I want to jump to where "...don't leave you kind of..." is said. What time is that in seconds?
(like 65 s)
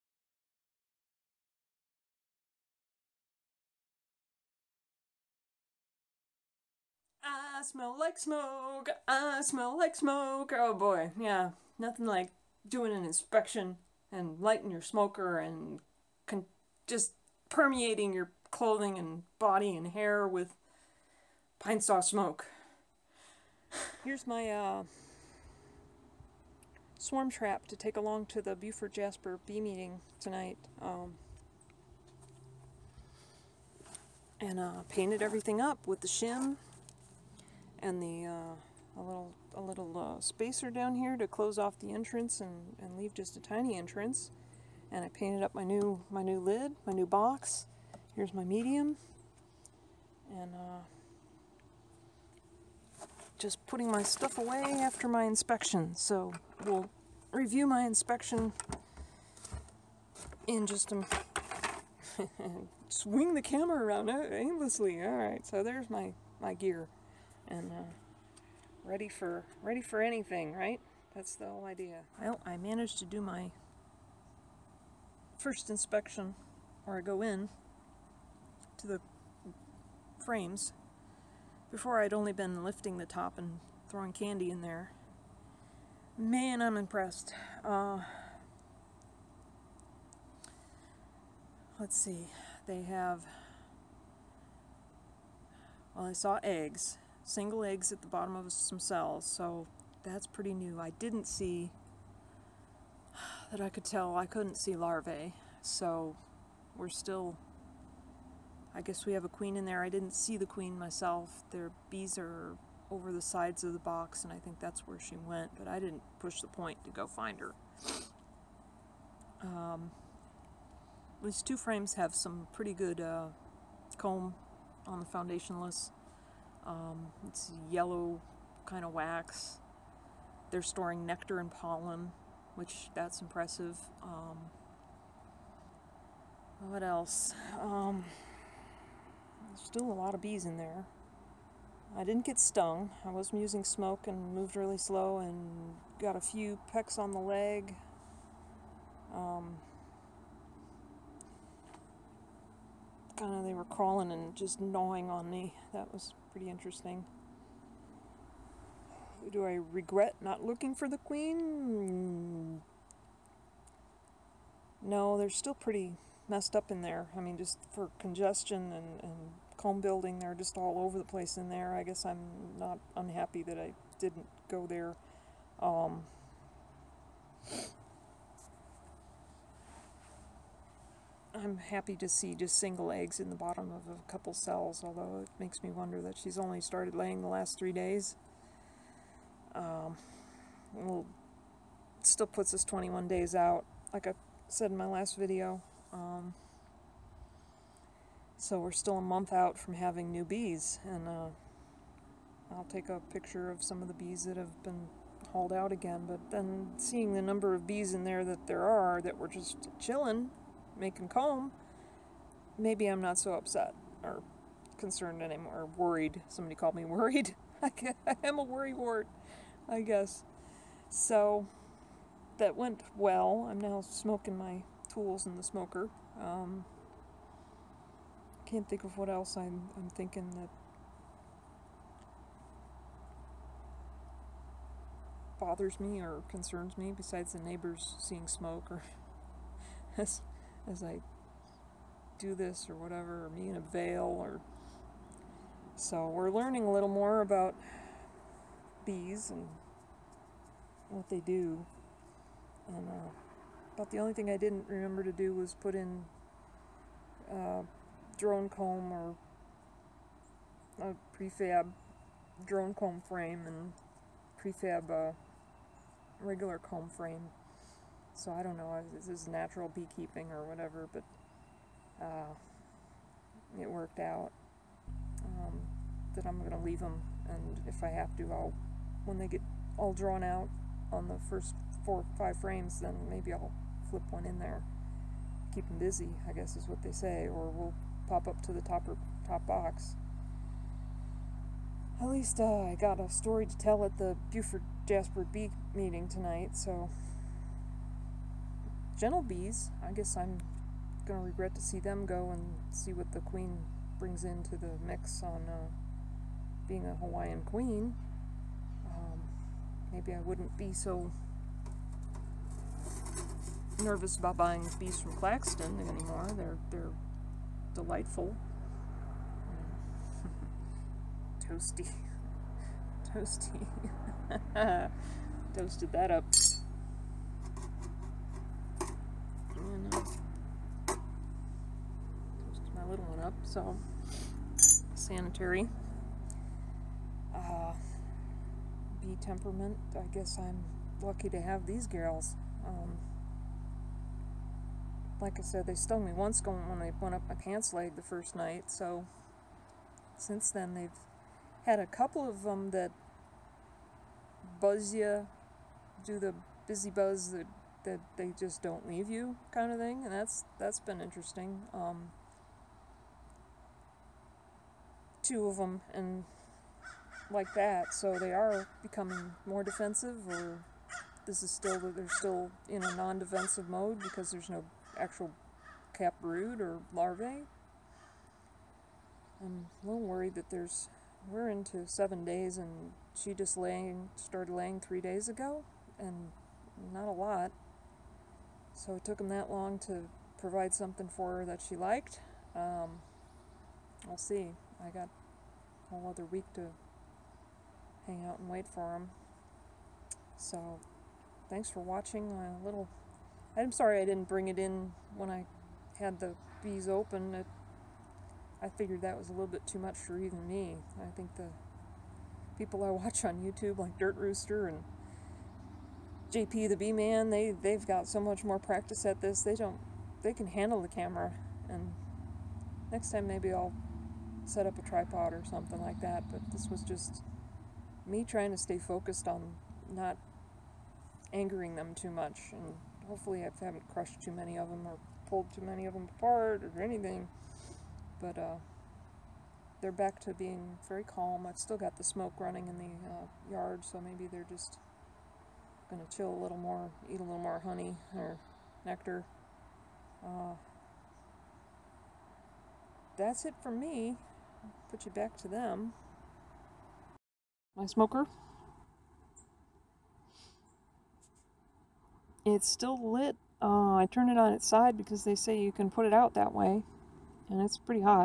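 358 s.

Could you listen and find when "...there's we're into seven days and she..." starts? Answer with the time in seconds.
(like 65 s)
380 s.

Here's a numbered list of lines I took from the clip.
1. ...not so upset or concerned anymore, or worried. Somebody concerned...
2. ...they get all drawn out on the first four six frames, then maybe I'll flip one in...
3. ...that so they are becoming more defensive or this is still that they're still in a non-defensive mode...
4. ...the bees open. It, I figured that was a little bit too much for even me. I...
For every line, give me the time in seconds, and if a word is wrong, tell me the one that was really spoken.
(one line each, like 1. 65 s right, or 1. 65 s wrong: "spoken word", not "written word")
1. 213 s wrong: "called", not "concerned"
2. 279 s wrong: "five", not "six"
3. 367 s right
4. 406 s right.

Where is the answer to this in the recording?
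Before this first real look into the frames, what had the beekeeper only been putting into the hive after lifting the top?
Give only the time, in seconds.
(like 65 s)
84 s.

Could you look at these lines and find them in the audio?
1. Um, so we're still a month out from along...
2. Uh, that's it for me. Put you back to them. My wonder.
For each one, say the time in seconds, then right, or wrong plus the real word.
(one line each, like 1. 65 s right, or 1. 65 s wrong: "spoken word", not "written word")
1. 195 s wrong: "having", not "along"
2. 450 s wrong: "smoker", not "wonder".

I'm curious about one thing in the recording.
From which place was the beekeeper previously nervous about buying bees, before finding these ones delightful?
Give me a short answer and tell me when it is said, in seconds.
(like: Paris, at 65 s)
Claxton, at 315 s.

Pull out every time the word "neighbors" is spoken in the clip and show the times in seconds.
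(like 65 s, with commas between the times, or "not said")
237 s.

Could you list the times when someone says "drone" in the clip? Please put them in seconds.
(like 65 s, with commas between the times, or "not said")
258 s, 262 s.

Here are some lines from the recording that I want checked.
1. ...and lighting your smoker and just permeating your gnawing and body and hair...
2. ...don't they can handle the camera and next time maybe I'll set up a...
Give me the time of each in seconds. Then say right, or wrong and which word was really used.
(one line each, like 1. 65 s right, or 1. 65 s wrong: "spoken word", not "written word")
1. 14 s wrong: "clothing", not "gnawing"
2. 419 s right.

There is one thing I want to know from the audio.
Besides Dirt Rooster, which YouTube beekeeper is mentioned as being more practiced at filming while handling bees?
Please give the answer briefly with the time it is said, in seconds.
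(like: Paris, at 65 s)
JP the Bee Man, at 416 s.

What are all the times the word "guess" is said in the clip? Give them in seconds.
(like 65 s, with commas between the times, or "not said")
108 s, 171 s, 219 s, 286 s, 299 s, 340 s.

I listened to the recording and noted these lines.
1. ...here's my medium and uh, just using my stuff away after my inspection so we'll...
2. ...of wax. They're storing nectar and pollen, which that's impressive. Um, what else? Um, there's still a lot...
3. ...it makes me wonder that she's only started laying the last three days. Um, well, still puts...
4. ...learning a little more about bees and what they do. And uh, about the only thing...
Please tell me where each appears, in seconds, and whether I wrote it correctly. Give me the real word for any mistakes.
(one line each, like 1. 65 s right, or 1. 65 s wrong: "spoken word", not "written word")
1. 48 s wrong: "putting", not "using"
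2. 128 s right
3. 185 s right
4. 246 s right.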